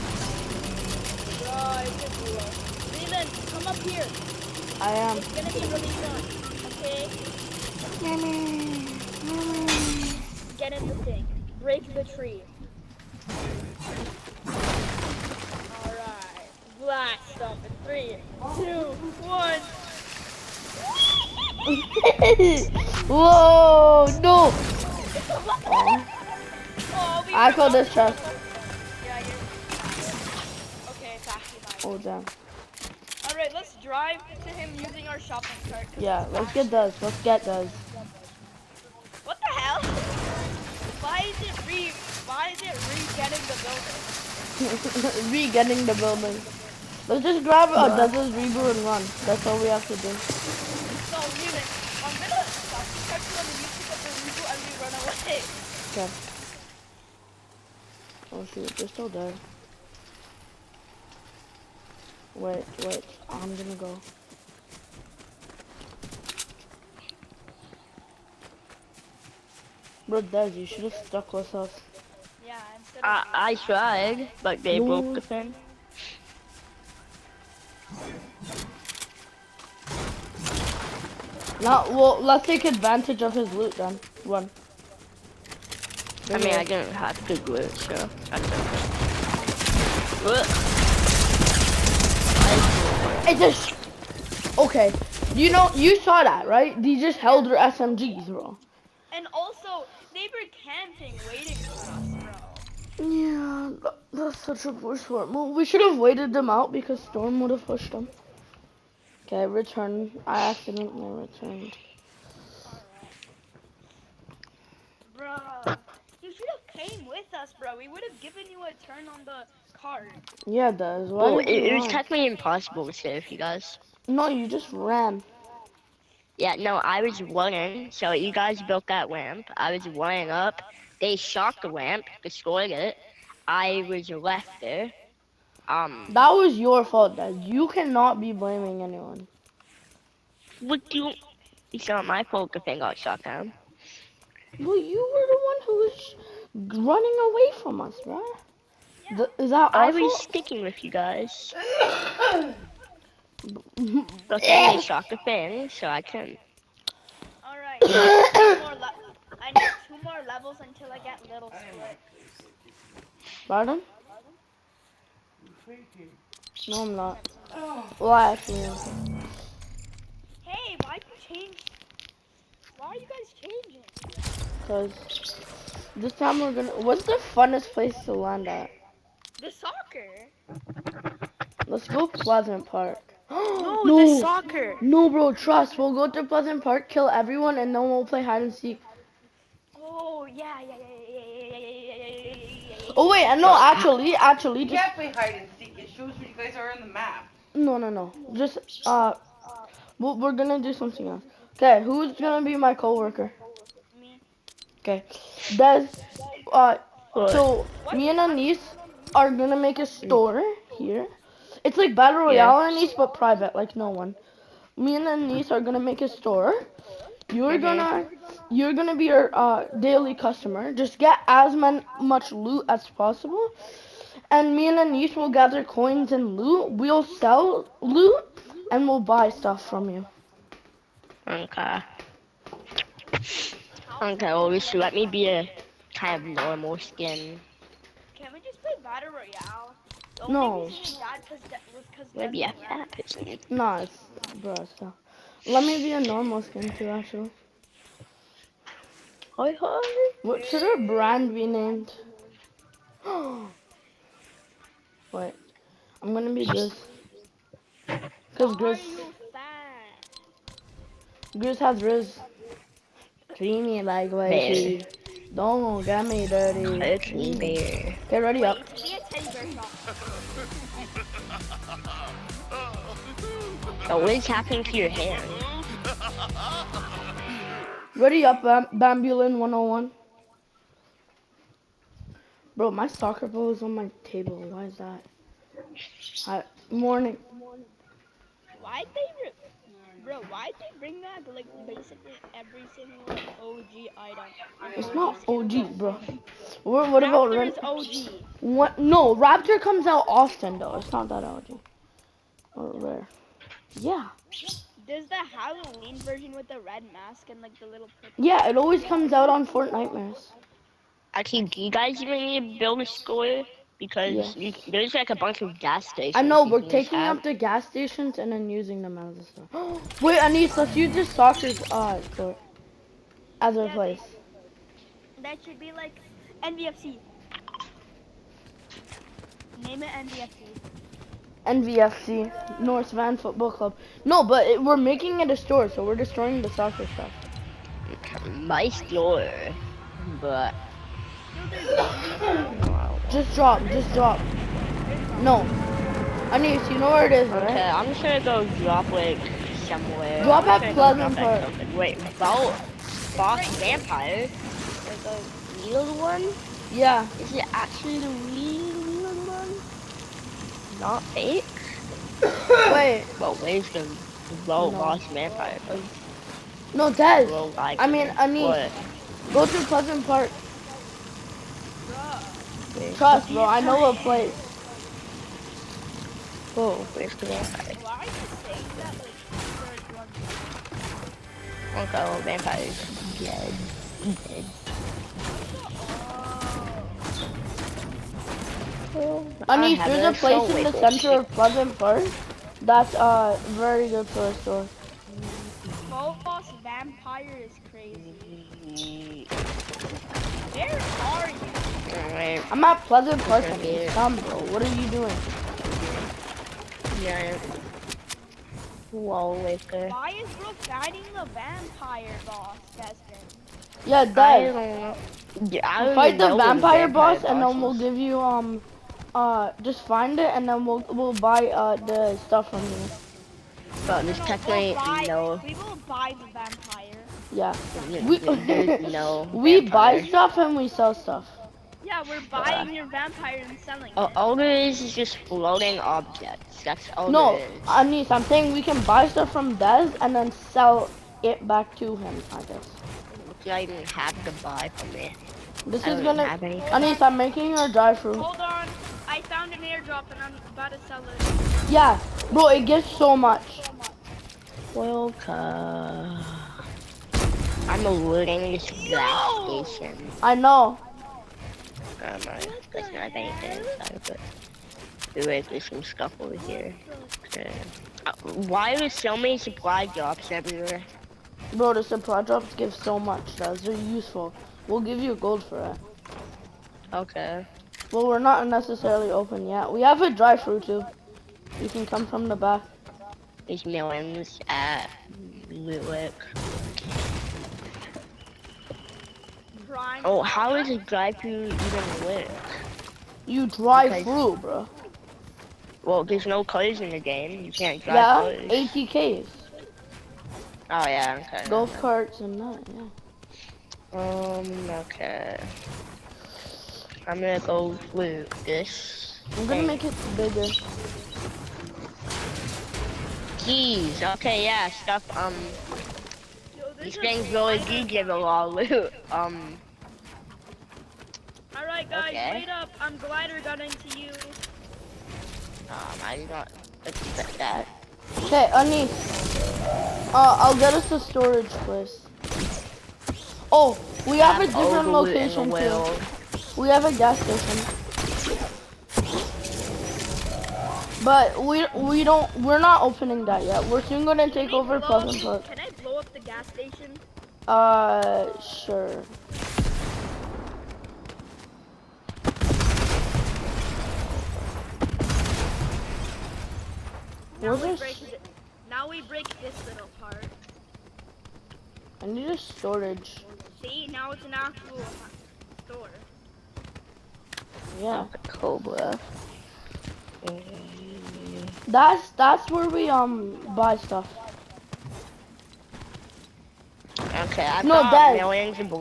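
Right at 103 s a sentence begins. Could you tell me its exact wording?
Yeah, that's such a poor smart move.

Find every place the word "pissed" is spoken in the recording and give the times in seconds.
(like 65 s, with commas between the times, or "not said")
not said.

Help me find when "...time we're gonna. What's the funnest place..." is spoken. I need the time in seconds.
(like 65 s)
176 s.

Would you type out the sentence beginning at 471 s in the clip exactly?
Bro, the supply drops give so much, guys.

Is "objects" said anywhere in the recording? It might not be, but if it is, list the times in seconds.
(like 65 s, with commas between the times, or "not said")
435 s.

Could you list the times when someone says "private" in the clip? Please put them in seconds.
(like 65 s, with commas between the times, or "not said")
213 s.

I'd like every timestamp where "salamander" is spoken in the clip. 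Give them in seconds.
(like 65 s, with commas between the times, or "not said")
not said.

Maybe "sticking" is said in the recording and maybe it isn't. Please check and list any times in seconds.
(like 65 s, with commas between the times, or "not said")
150 s.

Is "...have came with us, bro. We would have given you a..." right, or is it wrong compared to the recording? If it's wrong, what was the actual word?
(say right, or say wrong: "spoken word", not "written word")
right.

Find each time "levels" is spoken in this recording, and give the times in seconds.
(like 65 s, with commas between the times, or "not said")
160 s.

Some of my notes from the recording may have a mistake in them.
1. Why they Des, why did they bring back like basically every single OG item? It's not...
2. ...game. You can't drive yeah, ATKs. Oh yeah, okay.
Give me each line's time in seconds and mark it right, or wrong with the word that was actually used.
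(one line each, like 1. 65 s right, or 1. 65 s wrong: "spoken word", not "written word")
1. 288 s wrong: "Bro", not "Des"
2. 496 s right.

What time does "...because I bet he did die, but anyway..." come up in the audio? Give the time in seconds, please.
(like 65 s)
462 s.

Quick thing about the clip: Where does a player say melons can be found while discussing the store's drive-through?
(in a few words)
Lilac.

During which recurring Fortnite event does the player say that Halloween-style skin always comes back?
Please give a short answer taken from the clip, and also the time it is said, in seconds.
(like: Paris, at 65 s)
Fortnite Nightmares, at 309 s.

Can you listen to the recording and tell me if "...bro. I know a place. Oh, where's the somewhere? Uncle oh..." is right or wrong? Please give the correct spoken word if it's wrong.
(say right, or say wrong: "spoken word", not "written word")
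wrong: "vampire", not "somewhere".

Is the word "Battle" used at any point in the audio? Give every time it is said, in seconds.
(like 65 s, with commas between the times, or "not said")
211 s, 238 s.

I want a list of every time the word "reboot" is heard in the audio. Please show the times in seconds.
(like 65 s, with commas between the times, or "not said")
48 s, 54 s.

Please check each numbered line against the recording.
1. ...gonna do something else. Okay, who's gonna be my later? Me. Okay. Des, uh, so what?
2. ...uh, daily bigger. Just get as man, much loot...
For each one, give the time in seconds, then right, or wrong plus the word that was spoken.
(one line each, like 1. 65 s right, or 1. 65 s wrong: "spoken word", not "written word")
1. 200 s wrong: "coworker", not "later"
2. 219 s wrong: "customer", not "bigger".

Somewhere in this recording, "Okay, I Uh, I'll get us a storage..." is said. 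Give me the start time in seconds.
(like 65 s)
528 s.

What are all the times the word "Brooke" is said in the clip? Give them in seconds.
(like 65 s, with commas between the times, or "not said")
410 s.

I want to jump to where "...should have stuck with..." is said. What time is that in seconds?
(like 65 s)
70 s.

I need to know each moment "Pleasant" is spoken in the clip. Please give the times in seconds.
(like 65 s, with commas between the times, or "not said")
182 s, 186 s, 350 s, 369 s, 391 s, 402 s, 544 s.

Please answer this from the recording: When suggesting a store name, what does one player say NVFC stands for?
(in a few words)
North Van Football Club.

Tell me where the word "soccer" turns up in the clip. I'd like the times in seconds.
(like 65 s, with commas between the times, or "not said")
179 s, 184 s, 282 s, 321 s, 336 s.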